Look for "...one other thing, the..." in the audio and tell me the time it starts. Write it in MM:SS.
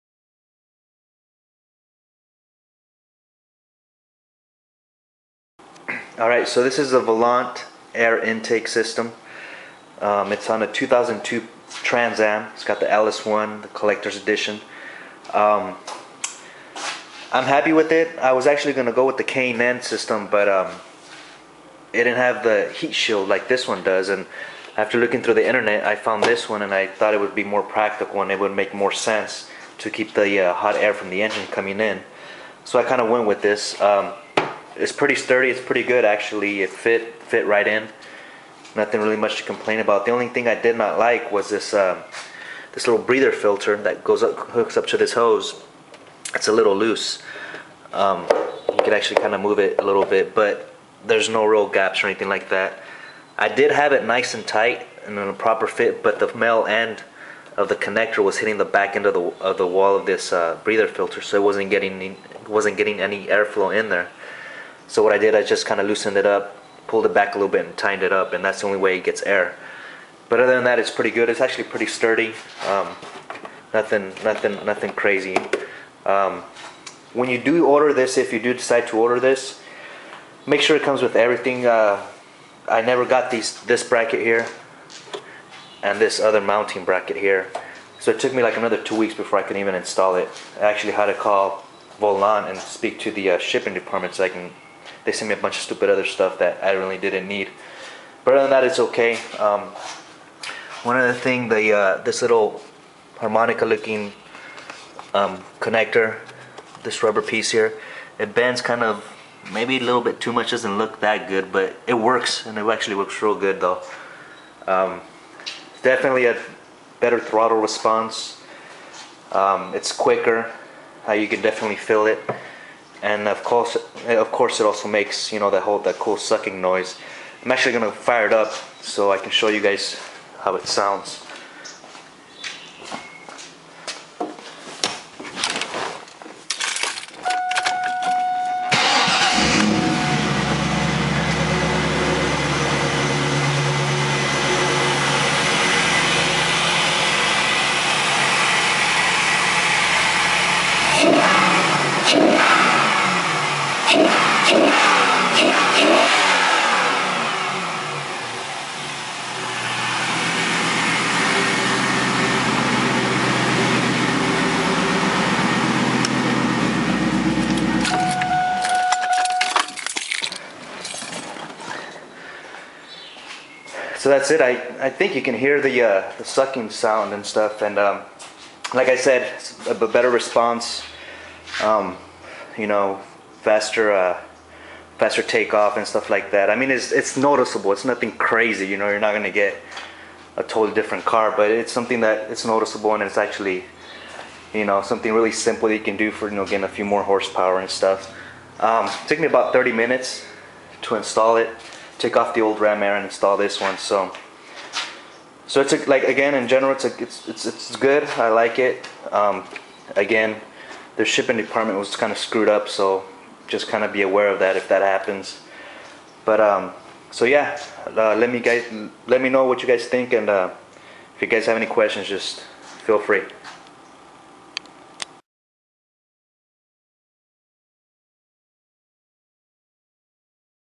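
01:40.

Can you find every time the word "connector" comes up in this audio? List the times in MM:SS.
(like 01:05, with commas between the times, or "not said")
00:57, 01:45.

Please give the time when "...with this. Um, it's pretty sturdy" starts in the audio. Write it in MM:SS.
00:33.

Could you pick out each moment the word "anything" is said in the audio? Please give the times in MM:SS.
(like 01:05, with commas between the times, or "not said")
00:52.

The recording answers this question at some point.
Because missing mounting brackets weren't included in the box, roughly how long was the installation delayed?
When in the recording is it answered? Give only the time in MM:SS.
01:28.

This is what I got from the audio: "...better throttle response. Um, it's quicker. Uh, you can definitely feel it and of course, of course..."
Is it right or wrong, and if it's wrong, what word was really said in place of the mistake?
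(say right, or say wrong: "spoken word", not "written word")
right.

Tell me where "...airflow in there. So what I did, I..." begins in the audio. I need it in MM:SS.
01:03.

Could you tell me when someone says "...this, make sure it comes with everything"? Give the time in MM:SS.
01:19.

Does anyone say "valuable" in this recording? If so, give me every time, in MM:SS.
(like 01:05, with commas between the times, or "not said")
not said.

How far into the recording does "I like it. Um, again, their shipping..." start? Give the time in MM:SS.
03:28.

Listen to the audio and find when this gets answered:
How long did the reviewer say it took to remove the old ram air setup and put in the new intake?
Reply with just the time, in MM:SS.
03:19.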